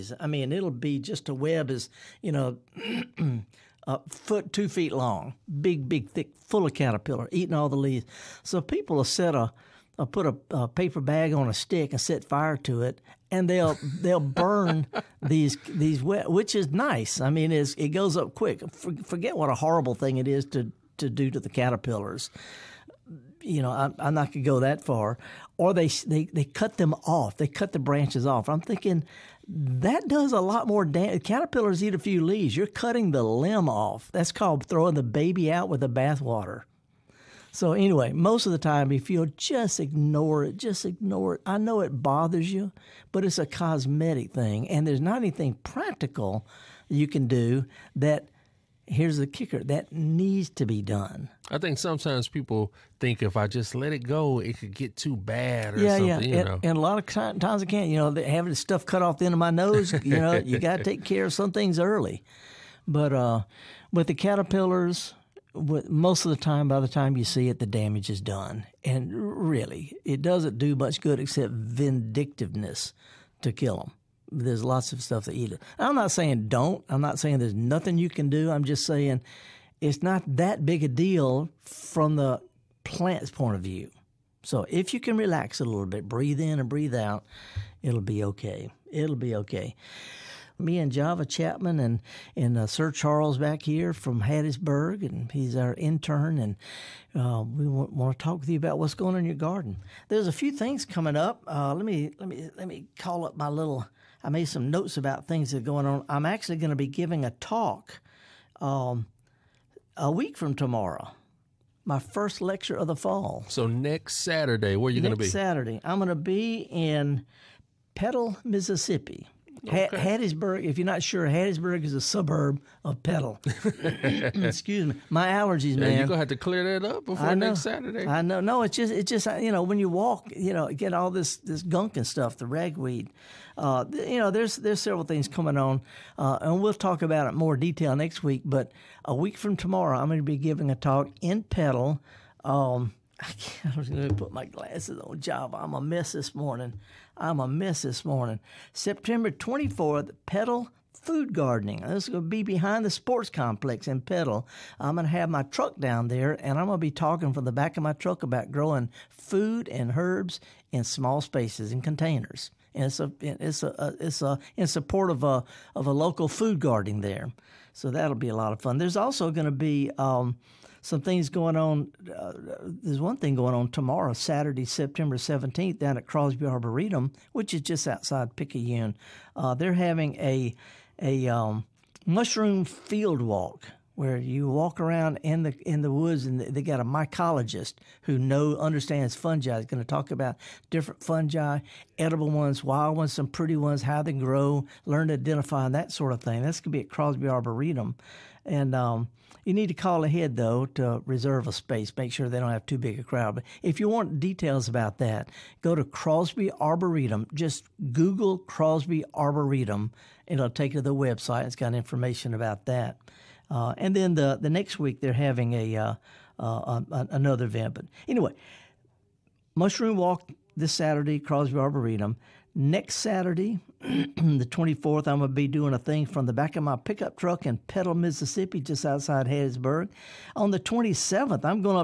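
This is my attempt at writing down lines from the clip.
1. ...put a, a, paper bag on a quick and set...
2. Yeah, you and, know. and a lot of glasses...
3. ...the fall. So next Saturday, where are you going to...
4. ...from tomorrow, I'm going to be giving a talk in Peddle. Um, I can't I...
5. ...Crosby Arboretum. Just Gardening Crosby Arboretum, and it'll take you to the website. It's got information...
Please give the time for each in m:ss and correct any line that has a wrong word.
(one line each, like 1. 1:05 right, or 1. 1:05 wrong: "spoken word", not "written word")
1. 0:10 wrong: "stick", not "quick"
2. 0:56 wrong: "times", not "glasses"
3. 1:52 right
4. 2:19 right
5. 3:25 wrong: "Google", not "Gardening".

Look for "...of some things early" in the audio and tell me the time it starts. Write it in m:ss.
1:01.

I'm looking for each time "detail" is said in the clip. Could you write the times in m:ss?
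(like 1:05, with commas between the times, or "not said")
2:17, 3:24.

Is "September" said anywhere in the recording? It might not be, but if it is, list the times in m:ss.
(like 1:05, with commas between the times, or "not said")
2:28, 2:54.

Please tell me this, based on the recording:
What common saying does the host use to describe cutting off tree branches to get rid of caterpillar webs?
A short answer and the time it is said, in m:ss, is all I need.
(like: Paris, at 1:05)
Throwing the baby out with the bathwater, at 0:34.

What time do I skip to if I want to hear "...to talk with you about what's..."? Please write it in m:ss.
1:38.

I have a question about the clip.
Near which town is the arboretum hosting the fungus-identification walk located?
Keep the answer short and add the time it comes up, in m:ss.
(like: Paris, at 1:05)
Picayune, at 2:58.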